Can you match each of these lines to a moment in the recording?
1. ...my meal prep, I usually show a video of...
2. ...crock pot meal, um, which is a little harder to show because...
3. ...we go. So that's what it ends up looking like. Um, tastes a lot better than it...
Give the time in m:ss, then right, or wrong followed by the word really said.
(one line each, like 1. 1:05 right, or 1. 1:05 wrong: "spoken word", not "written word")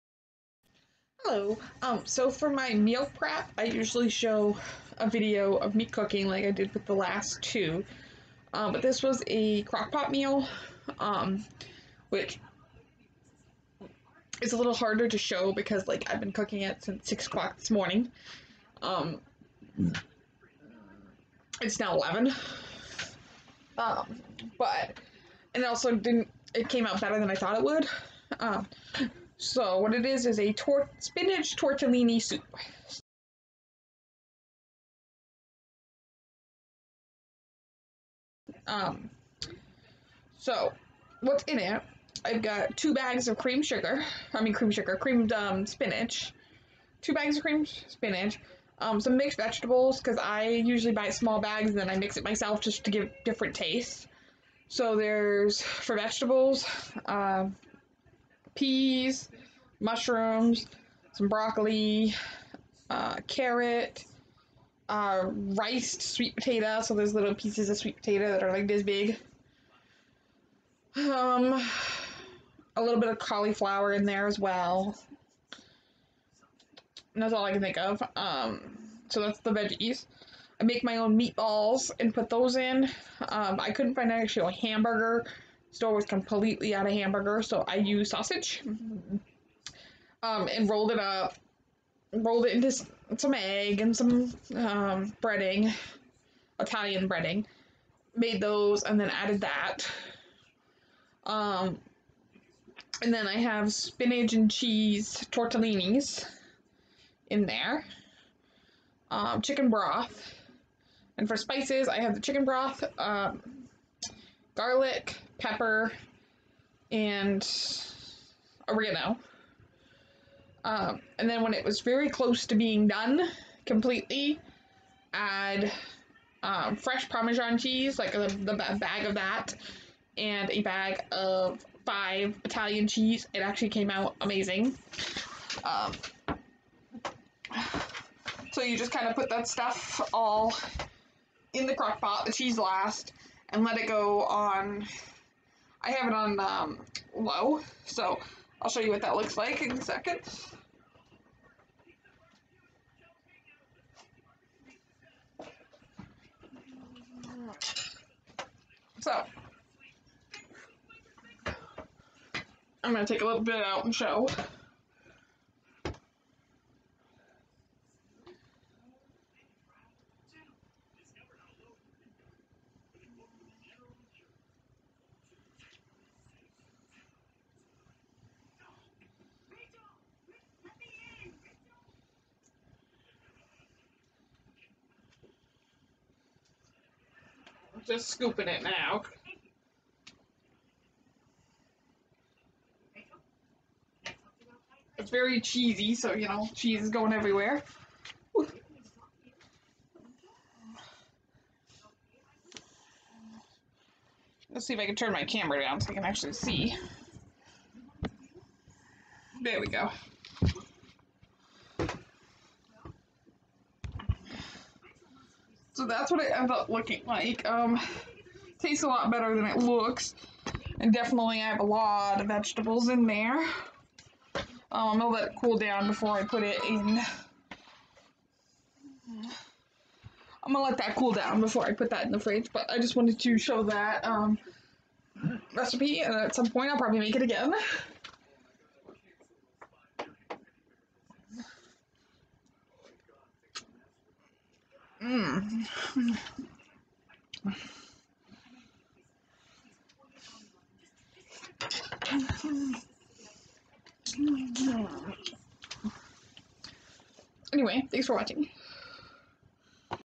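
1. 0:02 right
2. 0:09 right
3. 3:29 right.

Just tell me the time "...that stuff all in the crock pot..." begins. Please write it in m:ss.
2:19.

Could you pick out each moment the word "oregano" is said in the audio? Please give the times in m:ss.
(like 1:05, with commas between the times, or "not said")
1:58.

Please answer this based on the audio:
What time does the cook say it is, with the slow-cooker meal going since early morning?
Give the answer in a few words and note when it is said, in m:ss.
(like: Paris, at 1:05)
11, at 0:21.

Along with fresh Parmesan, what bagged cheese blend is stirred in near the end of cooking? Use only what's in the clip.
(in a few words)
five Italian cheese.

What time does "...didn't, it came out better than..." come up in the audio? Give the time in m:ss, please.
0:25.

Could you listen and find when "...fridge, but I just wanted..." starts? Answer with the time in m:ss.
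3:52.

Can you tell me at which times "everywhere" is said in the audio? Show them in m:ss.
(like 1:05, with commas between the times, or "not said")
3:17.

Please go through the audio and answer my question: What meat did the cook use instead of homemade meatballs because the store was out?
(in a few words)
sausage.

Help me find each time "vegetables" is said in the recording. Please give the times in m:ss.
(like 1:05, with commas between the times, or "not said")
0:49, 0:55, 3:42.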